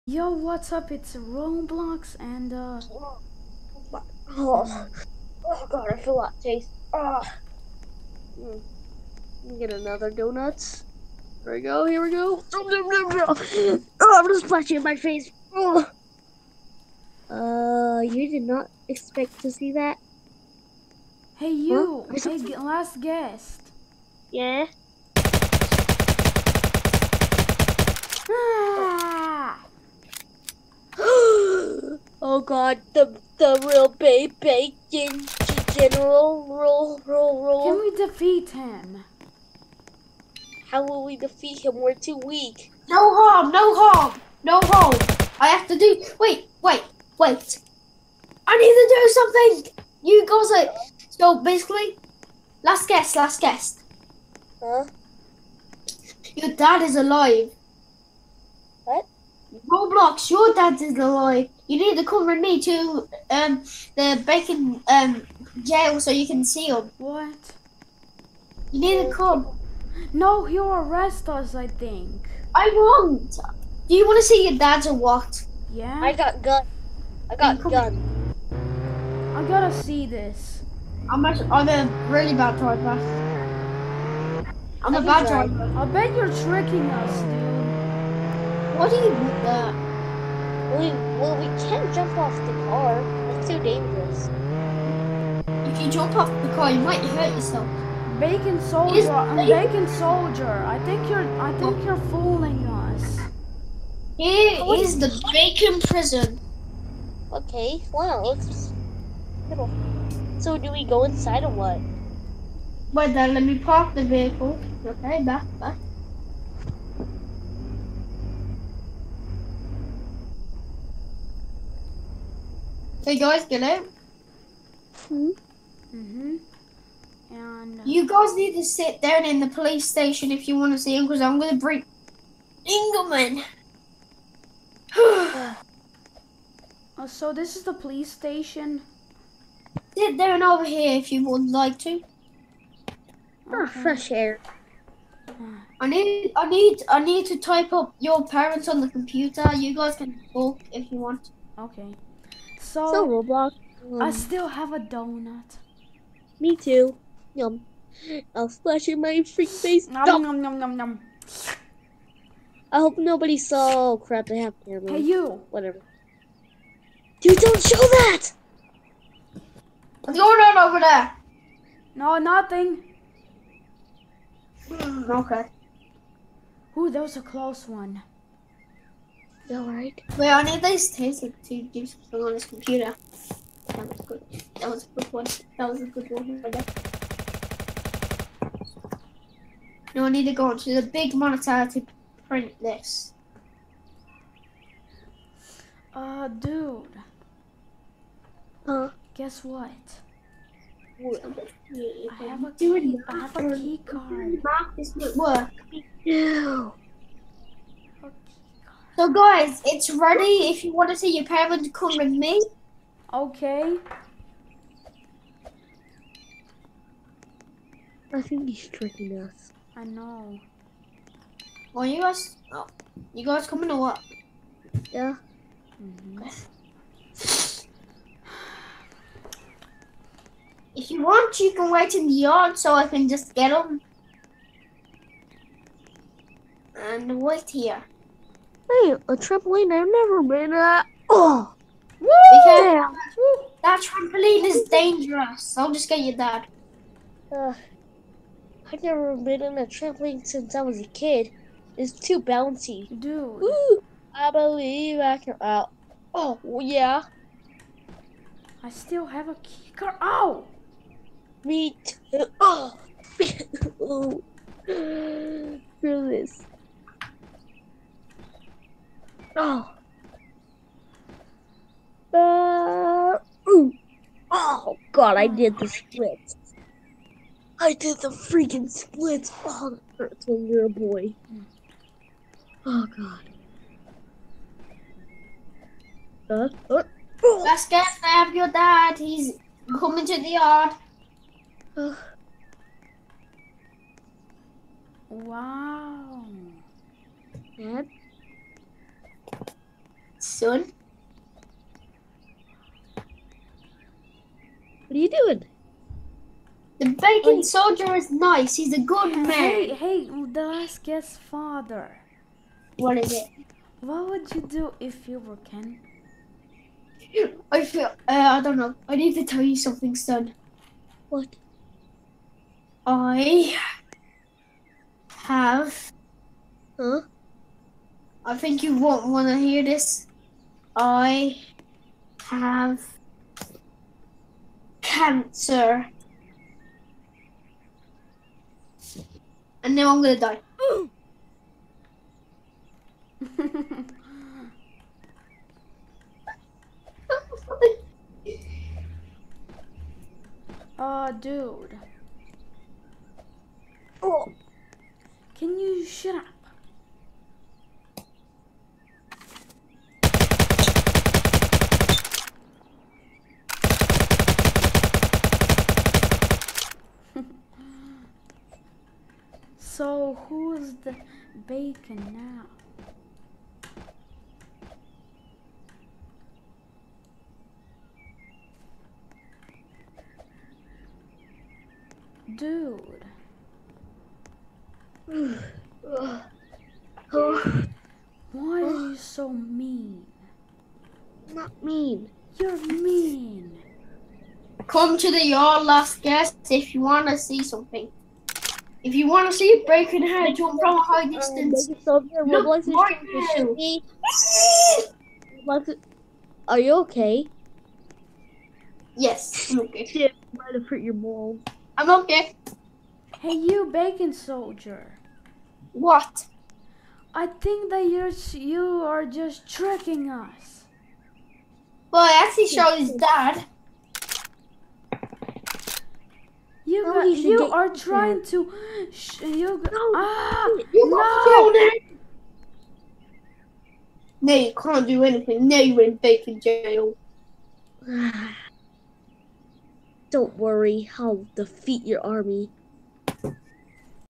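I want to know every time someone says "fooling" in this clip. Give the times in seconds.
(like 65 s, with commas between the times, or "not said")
102 s.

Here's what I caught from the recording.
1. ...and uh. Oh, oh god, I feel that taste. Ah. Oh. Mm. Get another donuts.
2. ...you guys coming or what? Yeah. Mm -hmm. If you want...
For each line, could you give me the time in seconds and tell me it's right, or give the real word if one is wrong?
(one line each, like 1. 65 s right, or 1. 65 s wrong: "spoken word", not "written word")
1. 2 s right
2. 223 s right.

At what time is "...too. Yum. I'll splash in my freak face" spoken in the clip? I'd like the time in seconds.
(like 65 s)
156 s.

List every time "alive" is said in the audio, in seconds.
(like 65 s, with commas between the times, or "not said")
56 s, 60 s.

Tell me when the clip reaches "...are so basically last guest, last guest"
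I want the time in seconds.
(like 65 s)
50 s.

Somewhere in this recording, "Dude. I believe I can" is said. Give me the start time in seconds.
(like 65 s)
253 s.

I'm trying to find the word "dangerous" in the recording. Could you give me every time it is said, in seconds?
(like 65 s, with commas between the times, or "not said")
93 s, 244 s.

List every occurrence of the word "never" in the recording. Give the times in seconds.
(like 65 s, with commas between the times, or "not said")
239 s, 248 s.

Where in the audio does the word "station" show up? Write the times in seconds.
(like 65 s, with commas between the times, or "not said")
129 s, 138 s.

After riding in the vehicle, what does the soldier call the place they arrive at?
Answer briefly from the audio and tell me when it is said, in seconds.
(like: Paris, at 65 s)
bacon prison, at 105 s.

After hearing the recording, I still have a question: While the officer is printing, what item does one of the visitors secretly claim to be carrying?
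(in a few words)
key card.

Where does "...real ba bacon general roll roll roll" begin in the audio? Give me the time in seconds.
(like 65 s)
33 s.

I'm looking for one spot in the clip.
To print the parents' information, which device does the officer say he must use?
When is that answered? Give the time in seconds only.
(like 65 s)
190 s.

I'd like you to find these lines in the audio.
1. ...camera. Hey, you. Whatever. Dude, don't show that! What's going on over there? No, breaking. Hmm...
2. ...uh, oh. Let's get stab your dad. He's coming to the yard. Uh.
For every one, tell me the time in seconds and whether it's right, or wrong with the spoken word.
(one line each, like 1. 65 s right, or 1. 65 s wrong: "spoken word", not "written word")
1. 164 s wrong: "nothing", not "breaking"
2. 286 s right.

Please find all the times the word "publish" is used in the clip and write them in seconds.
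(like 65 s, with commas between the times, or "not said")
not said.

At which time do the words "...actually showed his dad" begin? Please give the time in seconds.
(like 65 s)
422 s.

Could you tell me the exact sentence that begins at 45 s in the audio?
I have to do wait, wait, wait.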